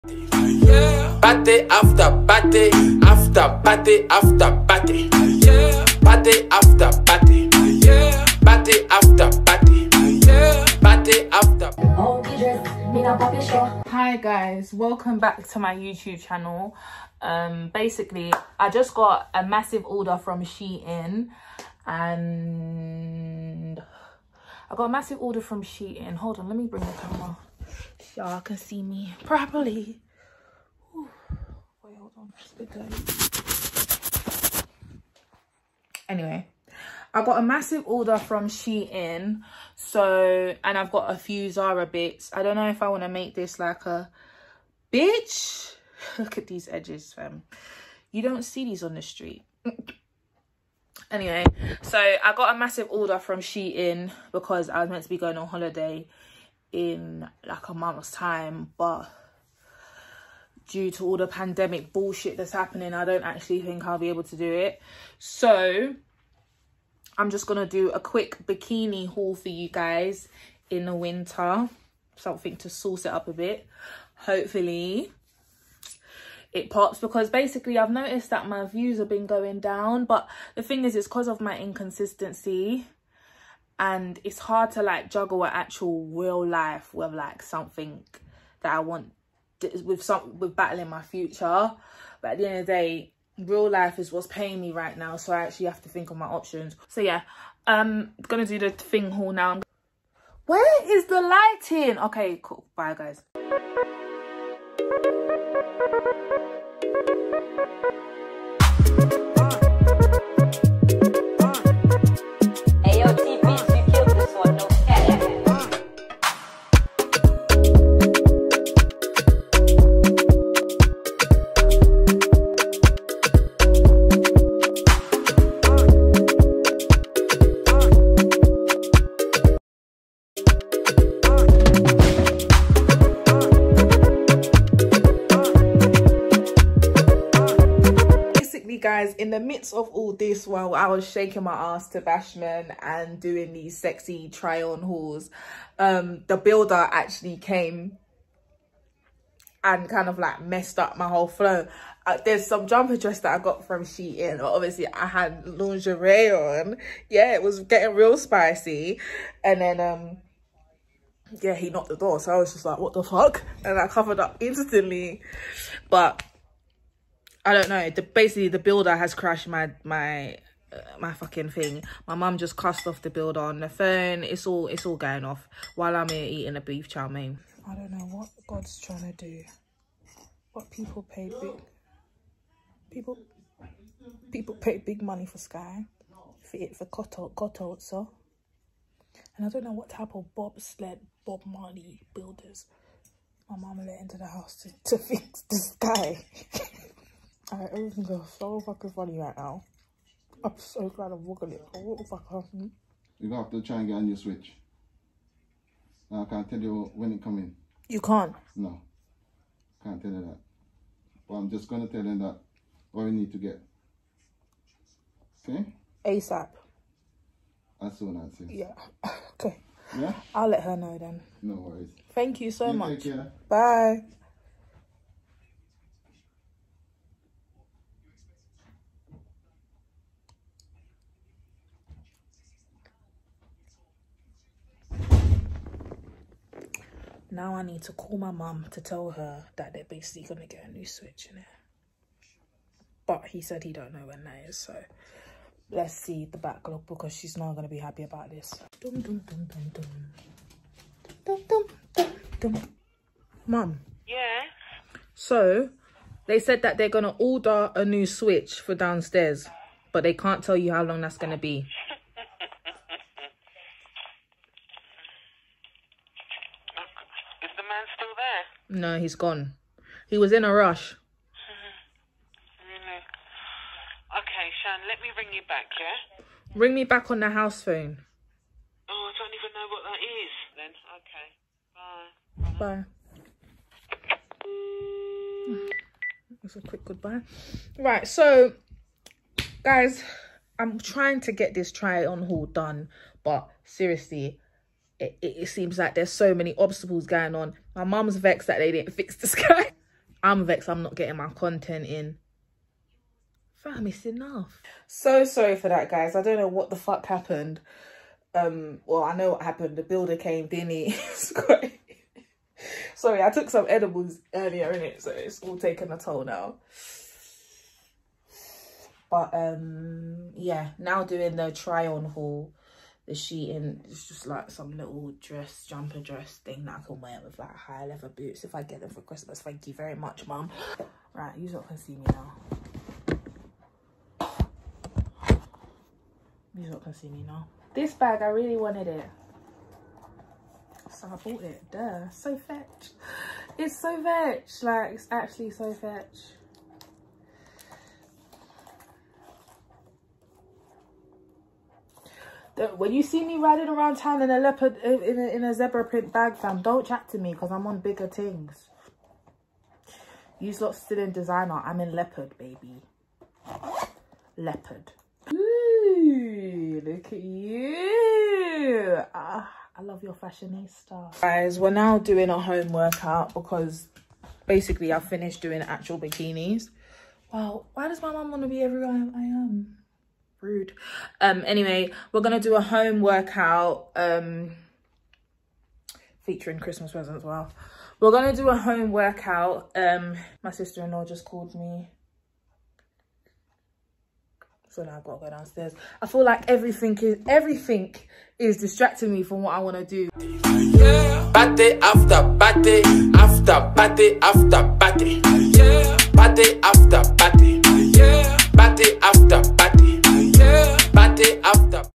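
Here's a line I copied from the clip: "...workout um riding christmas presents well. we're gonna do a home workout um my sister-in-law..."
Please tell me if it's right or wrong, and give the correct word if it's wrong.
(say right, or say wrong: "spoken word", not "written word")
wrong: "featuring", not "riding".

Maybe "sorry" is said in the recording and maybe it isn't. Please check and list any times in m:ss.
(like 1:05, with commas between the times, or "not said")
5:05, 5:12.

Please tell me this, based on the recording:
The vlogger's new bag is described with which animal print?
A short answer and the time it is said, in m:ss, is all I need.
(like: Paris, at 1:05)
Zebra print, at 5:55.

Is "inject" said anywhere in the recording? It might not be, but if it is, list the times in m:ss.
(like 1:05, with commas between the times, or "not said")
not said.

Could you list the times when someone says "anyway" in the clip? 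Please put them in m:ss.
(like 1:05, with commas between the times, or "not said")
0:36, 0:51, 6:21.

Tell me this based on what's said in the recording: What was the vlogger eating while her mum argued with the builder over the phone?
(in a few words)
Beef chow mein.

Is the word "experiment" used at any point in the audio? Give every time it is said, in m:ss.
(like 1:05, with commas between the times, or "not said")
not said.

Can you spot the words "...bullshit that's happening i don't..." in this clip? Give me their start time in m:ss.
1:01.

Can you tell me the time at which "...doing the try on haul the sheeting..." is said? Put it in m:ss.
5:21.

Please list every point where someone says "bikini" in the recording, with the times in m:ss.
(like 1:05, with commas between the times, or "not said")
1:08, 6:15.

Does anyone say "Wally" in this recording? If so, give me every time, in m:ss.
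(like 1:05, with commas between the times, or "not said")
not said.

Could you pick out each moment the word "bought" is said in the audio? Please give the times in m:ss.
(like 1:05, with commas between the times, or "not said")
5:41.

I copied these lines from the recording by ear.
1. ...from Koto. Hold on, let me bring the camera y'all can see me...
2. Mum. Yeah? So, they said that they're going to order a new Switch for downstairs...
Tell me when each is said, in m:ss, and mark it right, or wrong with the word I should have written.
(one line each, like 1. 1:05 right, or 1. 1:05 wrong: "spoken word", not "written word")
1. 0:25 wrong: "Shein", not "Koto"
2. 4:13 right.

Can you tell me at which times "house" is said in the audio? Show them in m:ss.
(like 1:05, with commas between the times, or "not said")
3:14, 4:37.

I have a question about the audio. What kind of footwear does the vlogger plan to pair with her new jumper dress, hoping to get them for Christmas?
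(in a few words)
High leather boots.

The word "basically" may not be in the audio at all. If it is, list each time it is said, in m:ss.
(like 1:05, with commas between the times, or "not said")
0:17, 1:17, 2:48, 3:59, 6:14.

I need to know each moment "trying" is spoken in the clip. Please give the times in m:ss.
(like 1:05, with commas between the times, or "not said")
2:58, 4:50.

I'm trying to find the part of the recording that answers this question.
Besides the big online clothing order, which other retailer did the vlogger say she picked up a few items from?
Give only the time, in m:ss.
0:41.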